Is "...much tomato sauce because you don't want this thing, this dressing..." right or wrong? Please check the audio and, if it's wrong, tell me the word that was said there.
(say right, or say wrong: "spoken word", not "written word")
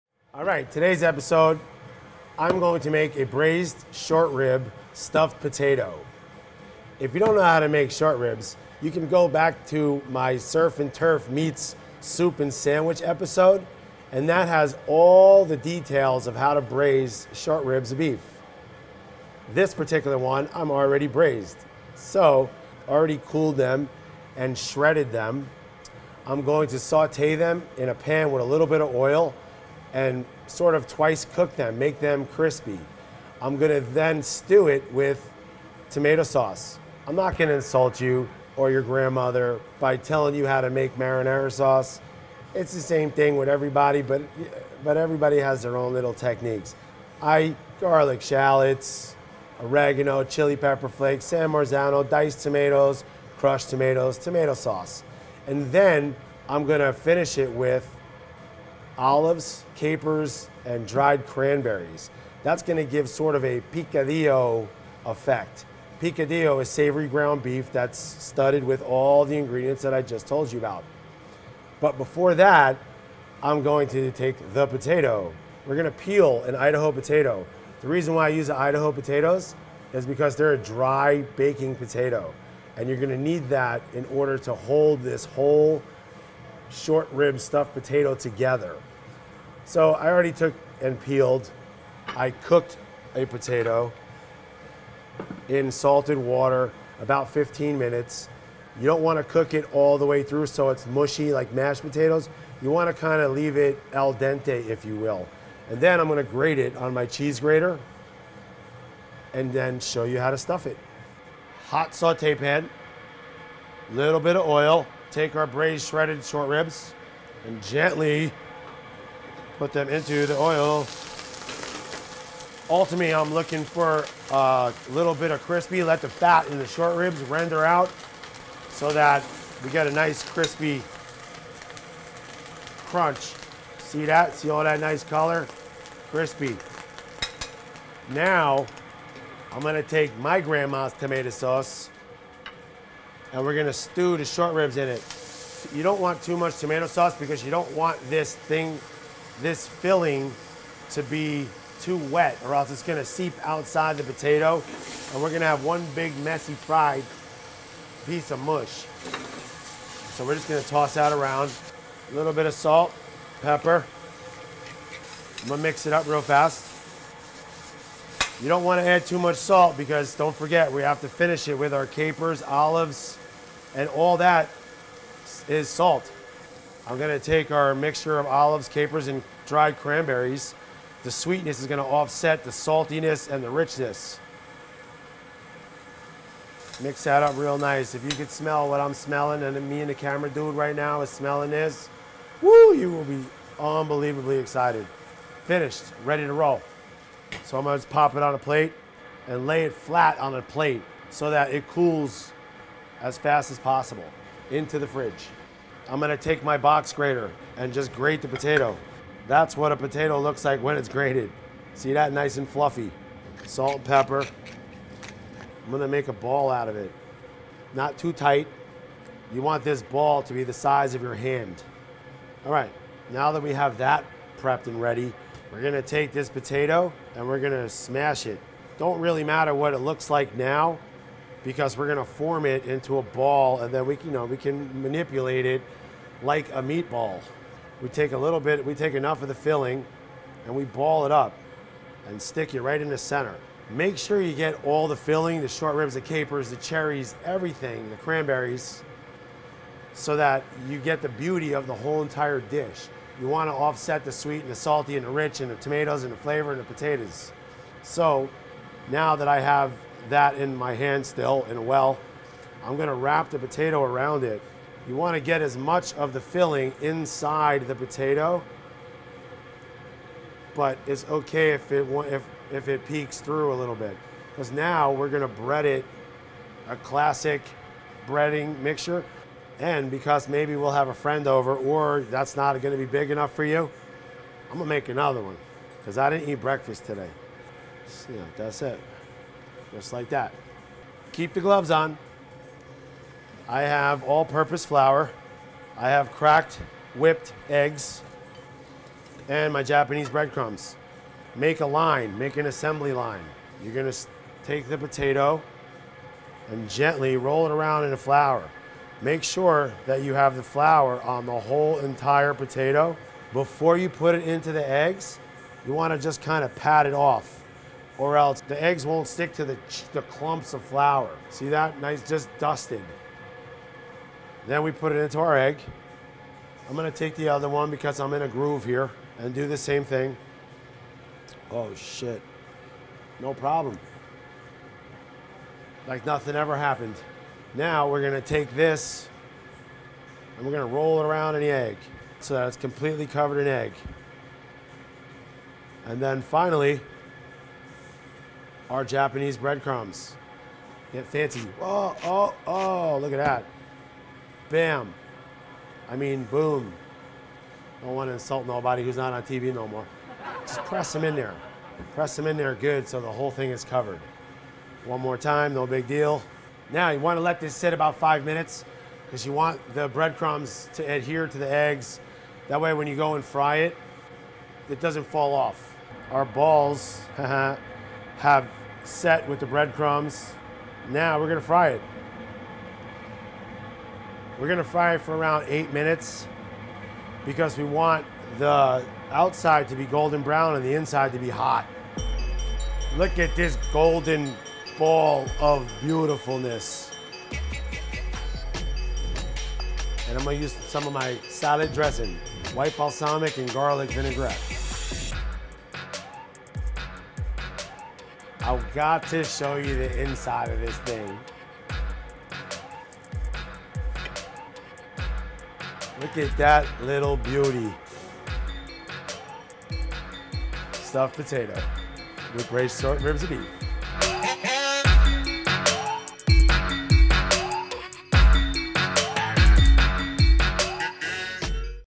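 wrong: "filling", not "dressing".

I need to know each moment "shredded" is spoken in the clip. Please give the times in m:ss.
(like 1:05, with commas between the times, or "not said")
0:24, 1:55.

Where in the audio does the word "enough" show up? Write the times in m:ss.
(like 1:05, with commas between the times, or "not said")
3:58, 4:43.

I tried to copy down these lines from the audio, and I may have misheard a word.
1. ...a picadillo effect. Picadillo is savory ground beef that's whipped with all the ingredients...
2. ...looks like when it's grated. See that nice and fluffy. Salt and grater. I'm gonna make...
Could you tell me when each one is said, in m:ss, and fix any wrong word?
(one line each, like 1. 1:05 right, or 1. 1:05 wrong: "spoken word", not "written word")
1. 1:03 wrong: "studded", not "whipped"
2. 3:30 wrong: "pepper", not "grater".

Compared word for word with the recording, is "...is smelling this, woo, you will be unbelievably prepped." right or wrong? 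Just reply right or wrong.
wrong.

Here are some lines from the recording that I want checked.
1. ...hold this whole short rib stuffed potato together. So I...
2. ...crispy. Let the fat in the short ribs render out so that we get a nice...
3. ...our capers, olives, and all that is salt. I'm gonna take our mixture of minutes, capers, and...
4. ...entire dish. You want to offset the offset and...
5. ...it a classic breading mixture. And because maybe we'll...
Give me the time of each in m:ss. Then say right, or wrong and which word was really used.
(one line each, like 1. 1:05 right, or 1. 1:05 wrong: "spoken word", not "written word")
1. 1:24 right
2. 2:05 right
3. 2:51 wrong: "olives", not "minutes"
4. 4:12 wrong: "sweet", not "offset"
5. 4:35 right.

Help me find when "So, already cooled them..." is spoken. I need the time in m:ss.
0:21.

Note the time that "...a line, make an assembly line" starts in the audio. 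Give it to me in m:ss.
5:01.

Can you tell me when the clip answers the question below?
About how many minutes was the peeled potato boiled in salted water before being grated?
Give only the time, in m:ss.
1:37.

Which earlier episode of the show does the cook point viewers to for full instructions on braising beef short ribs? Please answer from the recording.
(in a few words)
surf and turf meets soup and sandwich.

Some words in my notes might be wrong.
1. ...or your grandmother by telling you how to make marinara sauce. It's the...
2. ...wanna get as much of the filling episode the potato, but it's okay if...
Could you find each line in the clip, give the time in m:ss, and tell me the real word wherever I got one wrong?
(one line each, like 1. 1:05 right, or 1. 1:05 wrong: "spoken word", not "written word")
1. 0:38 right
2. 4:24 wrong: "inside", not "episode".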